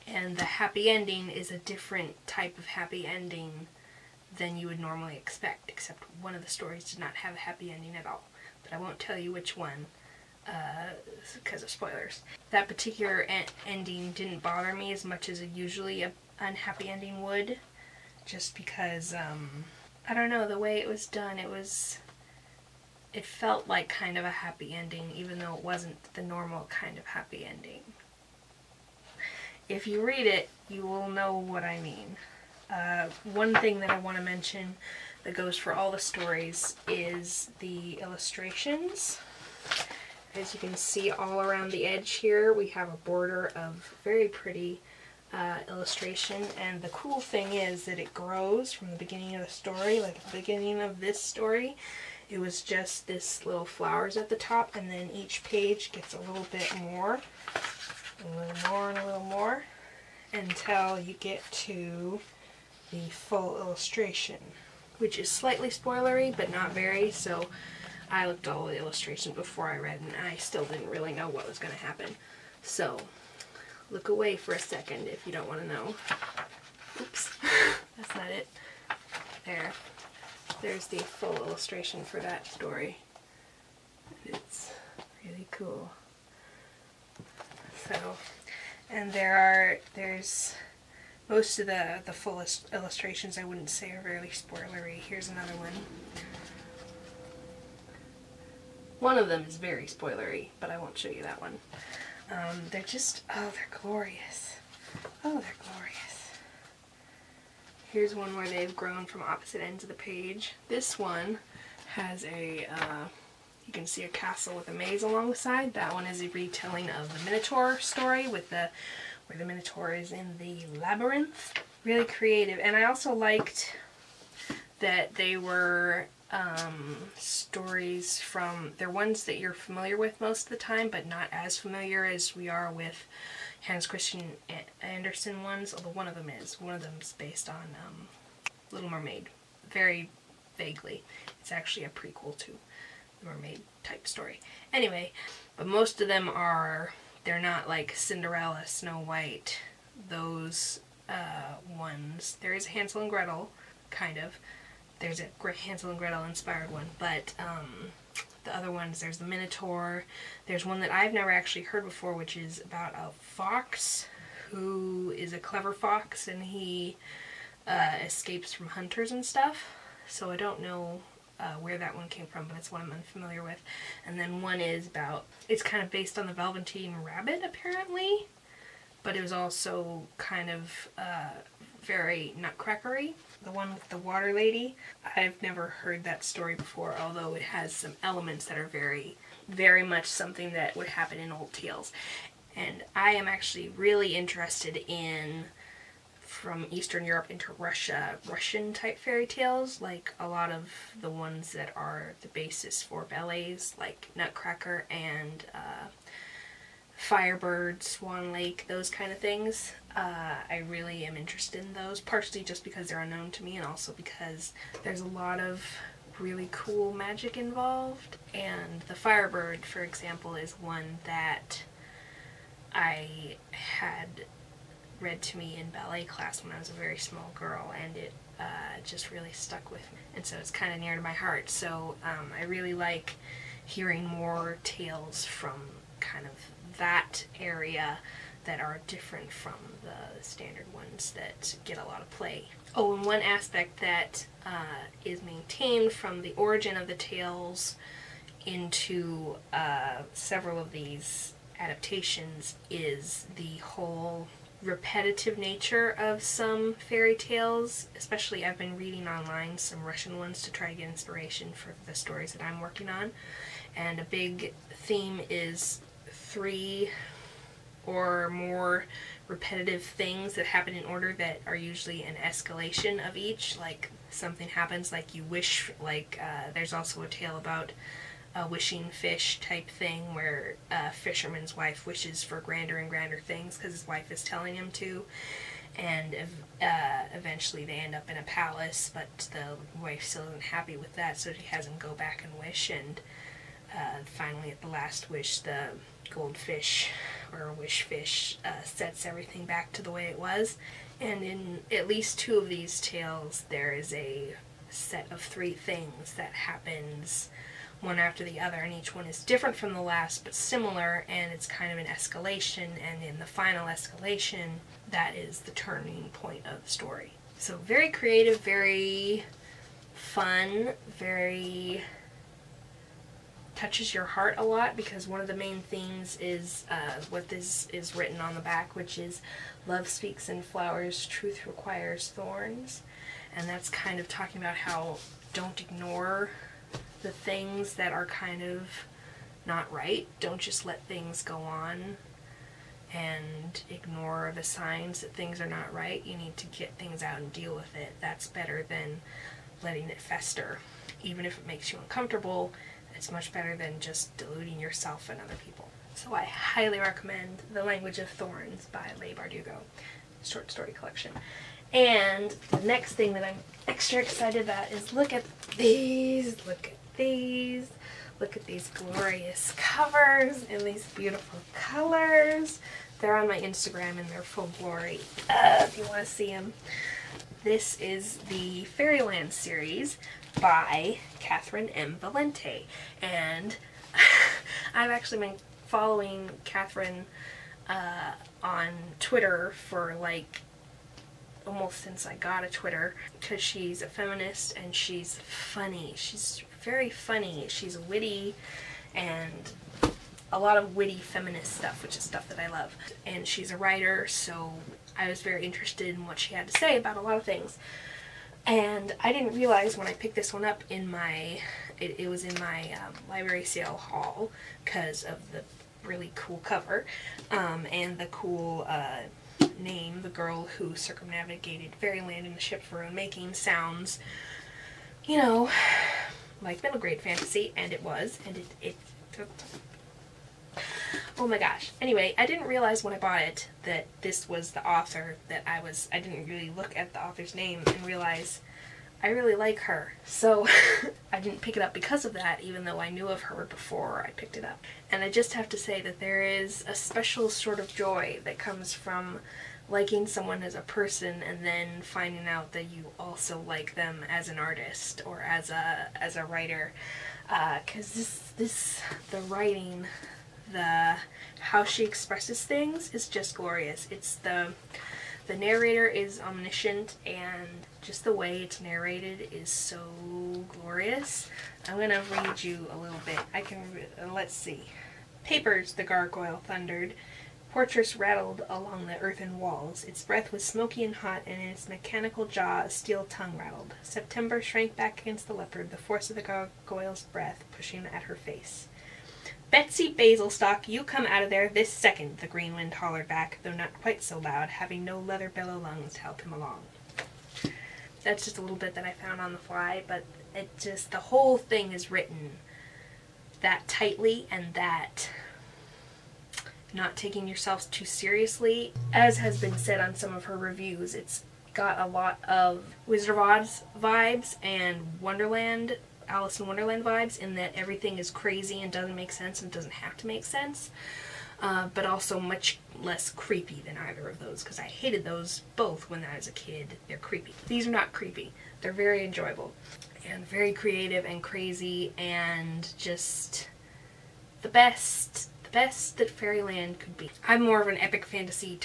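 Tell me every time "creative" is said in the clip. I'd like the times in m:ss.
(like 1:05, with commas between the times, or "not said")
2:02, 5:17, 8:50.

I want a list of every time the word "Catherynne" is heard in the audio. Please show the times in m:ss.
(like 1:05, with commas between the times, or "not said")
6:21, 6:26.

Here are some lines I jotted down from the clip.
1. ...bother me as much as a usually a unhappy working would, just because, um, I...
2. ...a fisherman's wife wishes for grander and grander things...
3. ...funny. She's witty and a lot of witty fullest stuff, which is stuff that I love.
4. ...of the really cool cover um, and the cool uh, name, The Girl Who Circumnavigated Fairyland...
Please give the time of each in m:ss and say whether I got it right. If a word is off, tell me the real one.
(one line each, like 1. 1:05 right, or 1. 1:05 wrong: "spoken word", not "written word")
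1. 0:14 wrong: "ending", not "working"
2. 4:40 right
3. 6:36 wrong: "feminist", not "fullest"
4. 6:55 right.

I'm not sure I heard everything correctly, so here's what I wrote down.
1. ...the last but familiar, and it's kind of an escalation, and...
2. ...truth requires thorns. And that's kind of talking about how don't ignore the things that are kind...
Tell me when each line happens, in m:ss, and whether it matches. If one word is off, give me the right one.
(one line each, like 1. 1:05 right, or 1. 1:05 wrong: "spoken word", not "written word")
1. 5:09 wrong: "similar", not "familiar"
2. 5:31 right.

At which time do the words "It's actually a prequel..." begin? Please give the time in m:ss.
2:21.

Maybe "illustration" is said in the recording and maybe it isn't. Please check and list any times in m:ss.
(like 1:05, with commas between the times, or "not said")
0:37, 0:45, 1:03, 1:08, 1:21, 1:32.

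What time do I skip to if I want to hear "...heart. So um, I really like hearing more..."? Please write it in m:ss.
3:51.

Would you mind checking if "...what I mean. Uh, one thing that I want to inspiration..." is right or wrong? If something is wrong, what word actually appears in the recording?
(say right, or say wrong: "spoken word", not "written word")
wrong: "mention", not "inspiration".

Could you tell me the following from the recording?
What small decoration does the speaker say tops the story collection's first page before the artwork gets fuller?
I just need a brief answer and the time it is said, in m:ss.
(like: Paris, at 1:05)
little flowers, at 0:53.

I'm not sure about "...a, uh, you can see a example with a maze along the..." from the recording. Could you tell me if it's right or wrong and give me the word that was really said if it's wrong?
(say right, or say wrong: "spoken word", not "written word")
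wrong: "castle", not "example".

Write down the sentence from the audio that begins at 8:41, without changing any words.
Uh, but also much less creepy than either of those because I hated those both when I was a kid.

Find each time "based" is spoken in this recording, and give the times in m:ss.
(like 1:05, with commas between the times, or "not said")
2:17, 2:55.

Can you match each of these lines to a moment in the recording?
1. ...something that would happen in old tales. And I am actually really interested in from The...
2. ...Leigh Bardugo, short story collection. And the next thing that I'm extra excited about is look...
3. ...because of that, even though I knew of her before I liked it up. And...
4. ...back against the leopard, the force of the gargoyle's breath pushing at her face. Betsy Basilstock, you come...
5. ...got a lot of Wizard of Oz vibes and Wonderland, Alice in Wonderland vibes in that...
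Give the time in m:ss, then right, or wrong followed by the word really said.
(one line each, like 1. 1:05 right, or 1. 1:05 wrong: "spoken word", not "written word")
1. 3:10 wrong: "Eastern", not "The"
2. 5:58 right
3. 7:21 wrong: "picked", not "liked"
4. 8:04 right
5. 8:31 right.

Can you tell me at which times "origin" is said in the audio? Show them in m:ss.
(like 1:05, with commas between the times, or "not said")
4:06.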